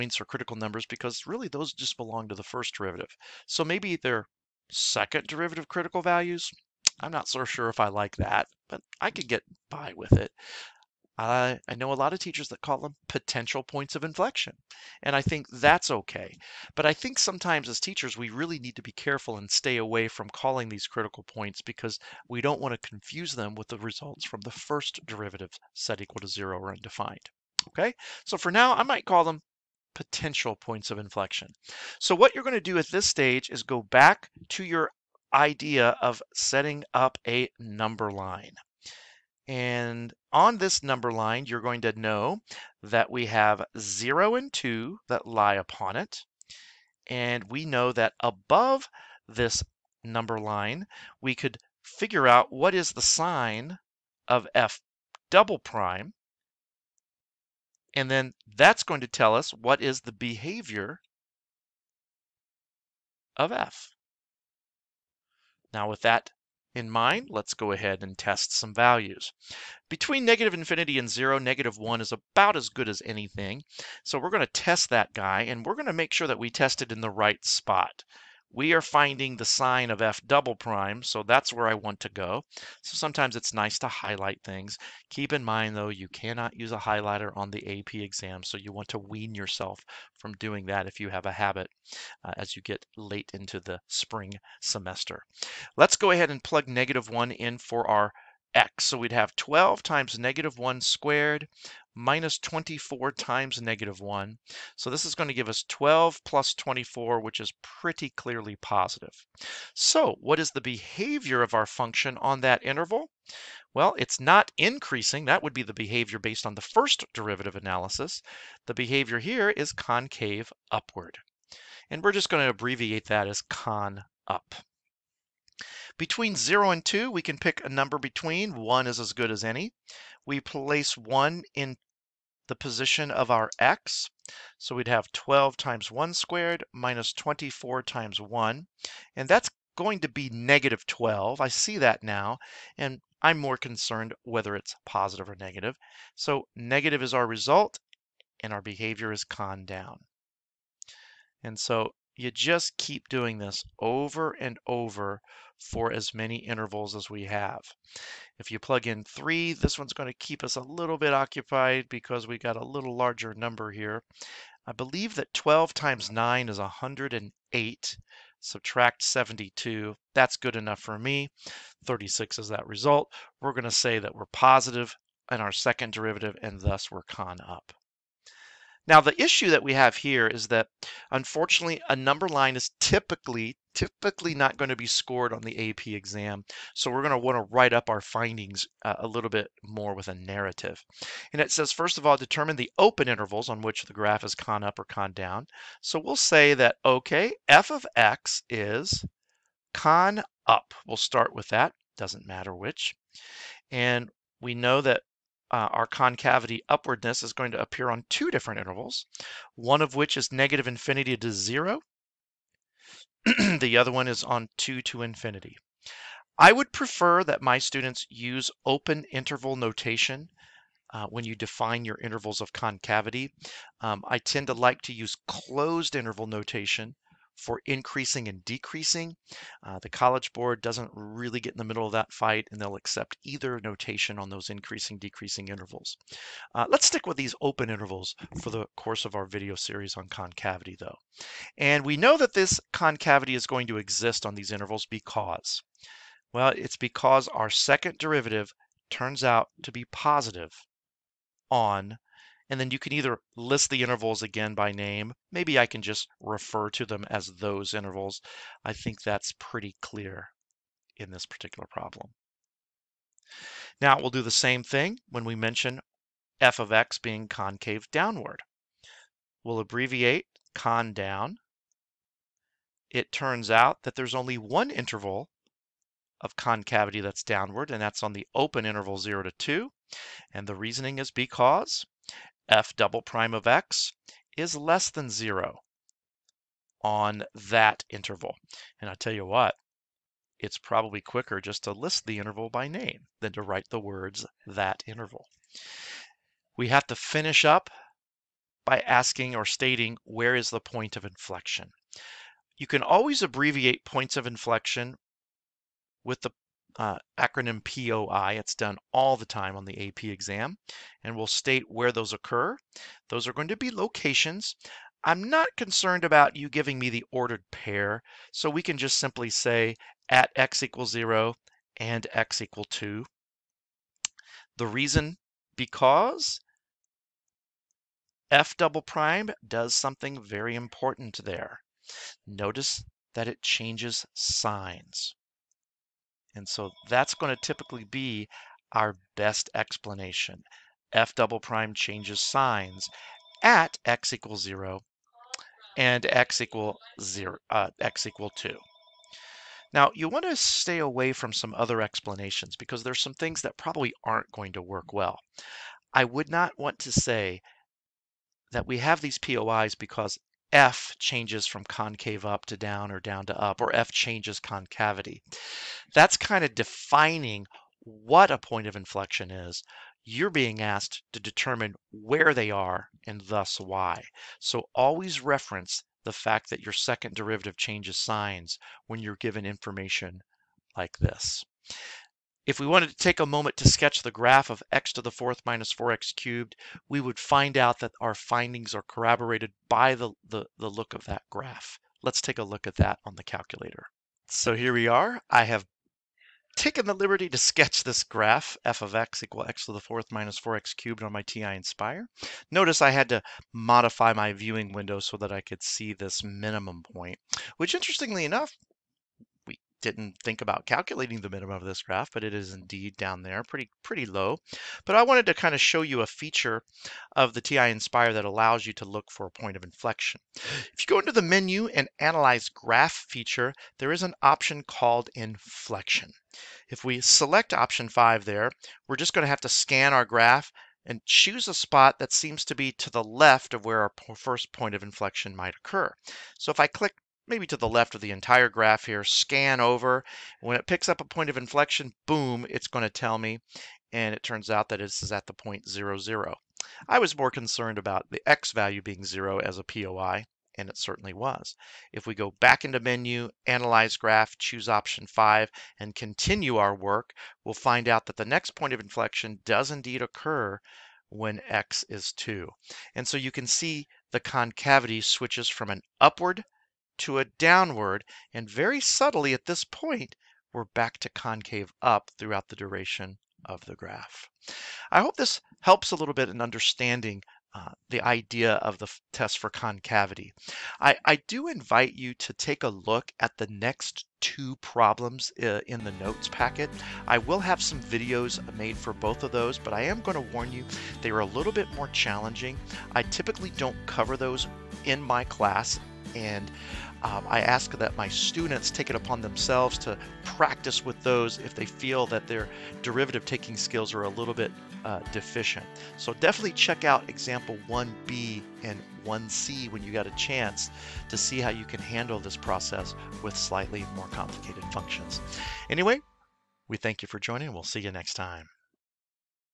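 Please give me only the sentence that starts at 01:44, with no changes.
So this is going to give us 12 plus 24, which is pretty clearly positive.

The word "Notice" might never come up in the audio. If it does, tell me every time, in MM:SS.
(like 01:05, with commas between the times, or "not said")
05:32, 06:42.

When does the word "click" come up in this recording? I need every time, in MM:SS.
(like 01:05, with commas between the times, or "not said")
07:16.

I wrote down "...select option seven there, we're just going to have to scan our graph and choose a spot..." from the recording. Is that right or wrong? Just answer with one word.
wrong.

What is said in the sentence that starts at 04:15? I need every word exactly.
Maybe I can just refer to them as those intervals.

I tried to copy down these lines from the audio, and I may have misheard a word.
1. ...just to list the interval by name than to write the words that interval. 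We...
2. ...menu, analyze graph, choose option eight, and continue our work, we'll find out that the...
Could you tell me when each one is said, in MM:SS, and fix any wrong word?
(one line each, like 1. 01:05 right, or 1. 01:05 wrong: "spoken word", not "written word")
1. 04:51 right
2. 07:32 wrong: "five", not "eight".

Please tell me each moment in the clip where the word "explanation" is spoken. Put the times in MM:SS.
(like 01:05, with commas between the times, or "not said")
05:39, 05:51.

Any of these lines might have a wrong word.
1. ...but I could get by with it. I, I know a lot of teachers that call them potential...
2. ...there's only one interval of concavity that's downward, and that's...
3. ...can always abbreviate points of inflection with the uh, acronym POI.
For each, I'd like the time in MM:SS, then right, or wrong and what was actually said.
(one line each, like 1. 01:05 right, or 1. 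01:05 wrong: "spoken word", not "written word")
1. 00:08 right
2. 04:33 right
3. 05:02 right.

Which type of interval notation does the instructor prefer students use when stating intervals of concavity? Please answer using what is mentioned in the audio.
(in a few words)
open interval notation.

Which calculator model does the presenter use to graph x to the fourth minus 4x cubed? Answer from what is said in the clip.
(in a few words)
TI-Nspire.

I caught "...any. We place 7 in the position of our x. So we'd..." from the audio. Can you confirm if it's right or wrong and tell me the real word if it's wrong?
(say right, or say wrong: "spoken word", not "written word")
wrong: "1", not "7".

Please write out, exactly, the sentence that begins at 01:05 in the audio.
Now with that in mind, let's go ahead and test some values.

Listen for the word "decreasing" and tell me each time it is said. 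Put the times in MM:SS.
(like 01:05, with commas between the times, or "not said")
03:48, 03:54.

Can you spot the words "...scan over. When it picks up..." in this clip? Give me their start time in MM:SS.
07:19.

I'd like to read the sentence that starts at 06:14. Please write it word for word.
So always reference the fact that your second derivative changes signs when you're given information like this.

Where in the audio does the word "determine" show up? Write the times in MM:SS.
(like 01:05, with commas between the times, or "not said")
03:12, 06:11.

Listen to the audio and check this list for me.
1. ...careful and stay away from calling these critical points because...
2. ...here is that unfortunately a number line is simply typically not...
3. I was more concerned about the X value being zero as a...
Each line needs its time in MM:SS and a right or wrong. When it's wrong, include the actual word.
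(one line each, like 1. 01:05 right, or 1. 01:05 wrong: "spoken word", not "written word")
1. 00:18 right
2. 02:59 wrong: "typically", not "simply"
3. 07:26 right.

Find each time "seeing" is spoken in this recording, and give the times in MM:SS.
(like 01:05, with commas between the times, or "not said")
not said.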